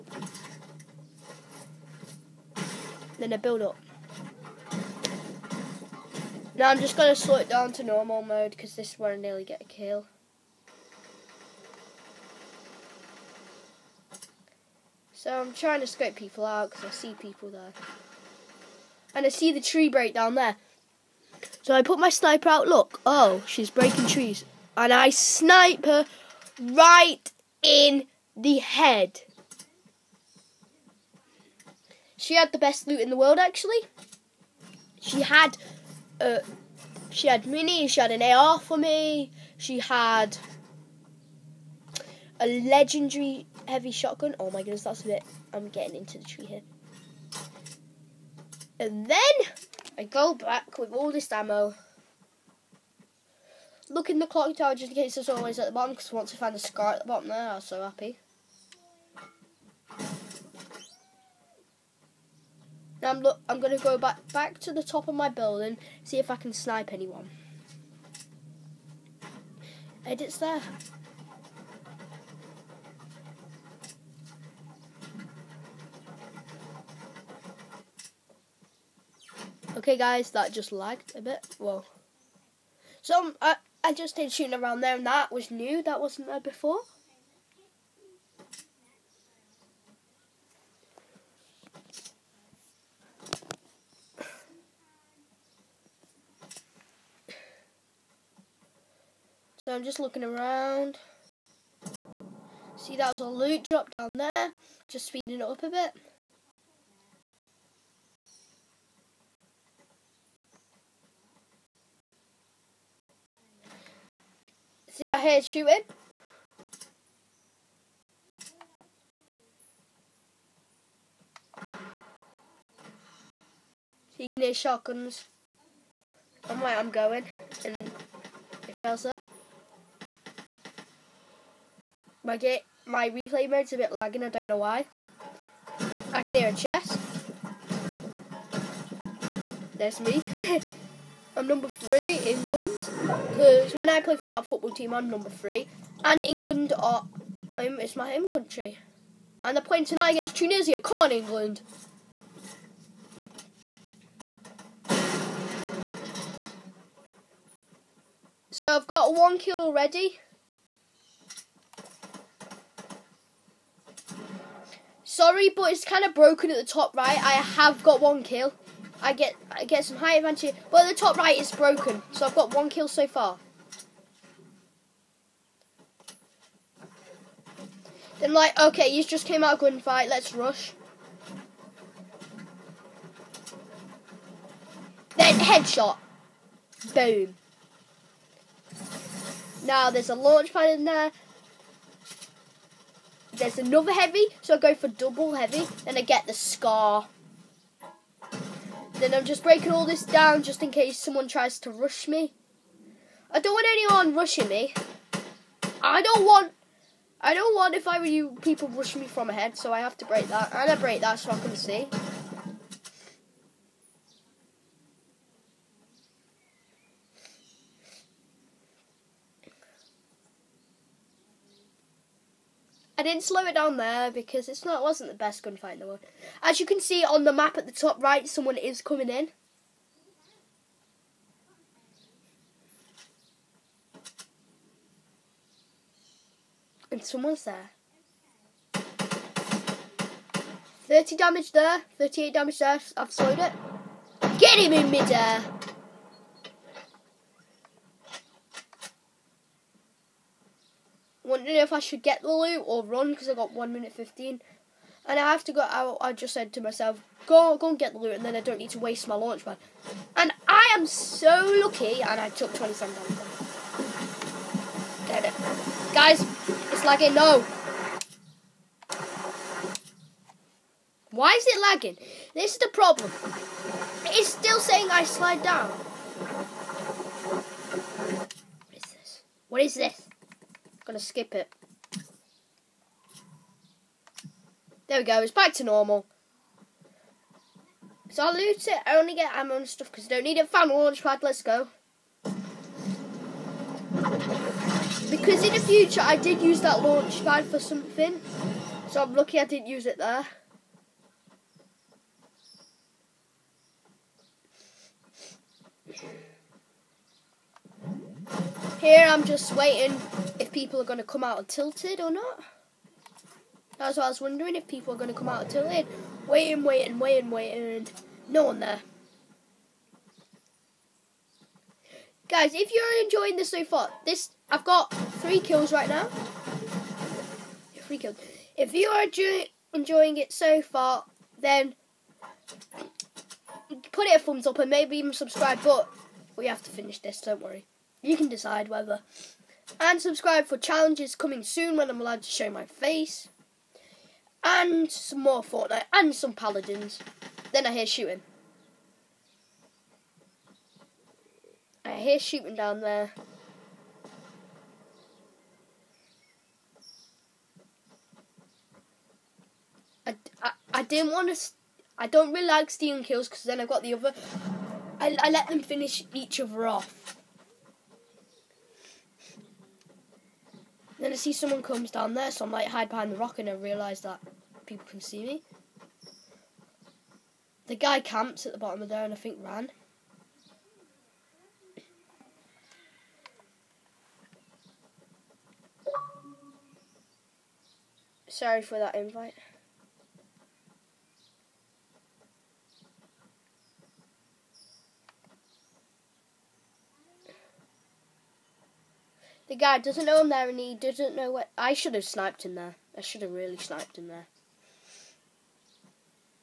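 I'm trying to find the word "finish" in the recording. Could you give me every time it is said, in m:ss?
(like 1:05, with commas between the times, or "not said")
5:36, 6:05.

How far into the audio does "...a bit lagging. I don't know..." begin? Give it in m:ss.
2:13.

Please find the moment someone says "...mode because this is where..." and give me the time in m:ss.
0:08.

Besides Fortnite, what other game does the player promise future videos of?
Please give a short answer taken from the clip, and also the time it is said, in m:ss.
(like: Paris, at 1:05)
Paladins, at 5:46.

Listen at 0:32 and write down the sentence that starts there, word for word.
She had the best loot in the world, actually.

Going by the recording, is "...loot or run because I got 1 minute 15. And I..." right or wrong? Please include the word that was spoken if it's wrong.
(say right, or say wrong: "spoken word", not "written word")
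right.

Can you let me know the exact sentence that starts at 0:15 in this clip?
I'm trying to scope people out because I see people there.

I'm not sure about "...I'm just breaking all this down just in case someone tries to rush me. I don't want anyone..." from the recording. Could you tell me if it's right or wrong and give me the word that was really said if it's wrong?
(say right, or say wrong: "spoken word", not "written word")
right.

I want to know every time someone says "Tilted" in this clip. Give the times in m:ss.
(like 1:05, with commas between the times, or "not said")
5:11, 5:15.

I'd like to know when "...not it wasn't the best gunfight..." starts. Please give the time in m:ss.
3:44.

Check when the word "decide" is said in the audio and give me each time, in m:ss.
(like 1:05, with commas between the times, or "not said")
5:38.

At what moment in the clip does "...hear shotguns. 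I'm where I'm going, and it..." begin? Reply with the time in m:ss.
2:04.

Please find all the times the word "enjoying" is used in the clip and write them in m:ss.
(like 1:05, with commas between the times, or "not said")
5:23, 5:29.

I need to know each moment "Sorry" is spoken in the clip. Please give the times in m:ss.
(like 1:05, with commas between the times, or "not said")
2:45, 6:28.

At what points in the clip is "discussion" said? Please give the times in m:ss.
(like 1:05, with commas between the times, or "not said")
not said.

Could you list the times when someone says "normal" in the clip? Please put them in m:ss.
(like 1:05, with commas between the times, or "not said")
0:07, 4:45.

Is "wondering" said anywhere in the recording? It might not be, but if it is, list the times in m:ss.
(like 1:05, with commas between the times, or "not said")
4:11, 5:14.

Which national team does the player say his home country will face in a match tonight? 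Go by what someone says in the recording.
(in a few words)
Tunisia.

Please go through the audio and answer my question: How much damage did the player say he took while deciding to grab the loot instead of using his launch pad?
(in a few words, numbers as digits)
27.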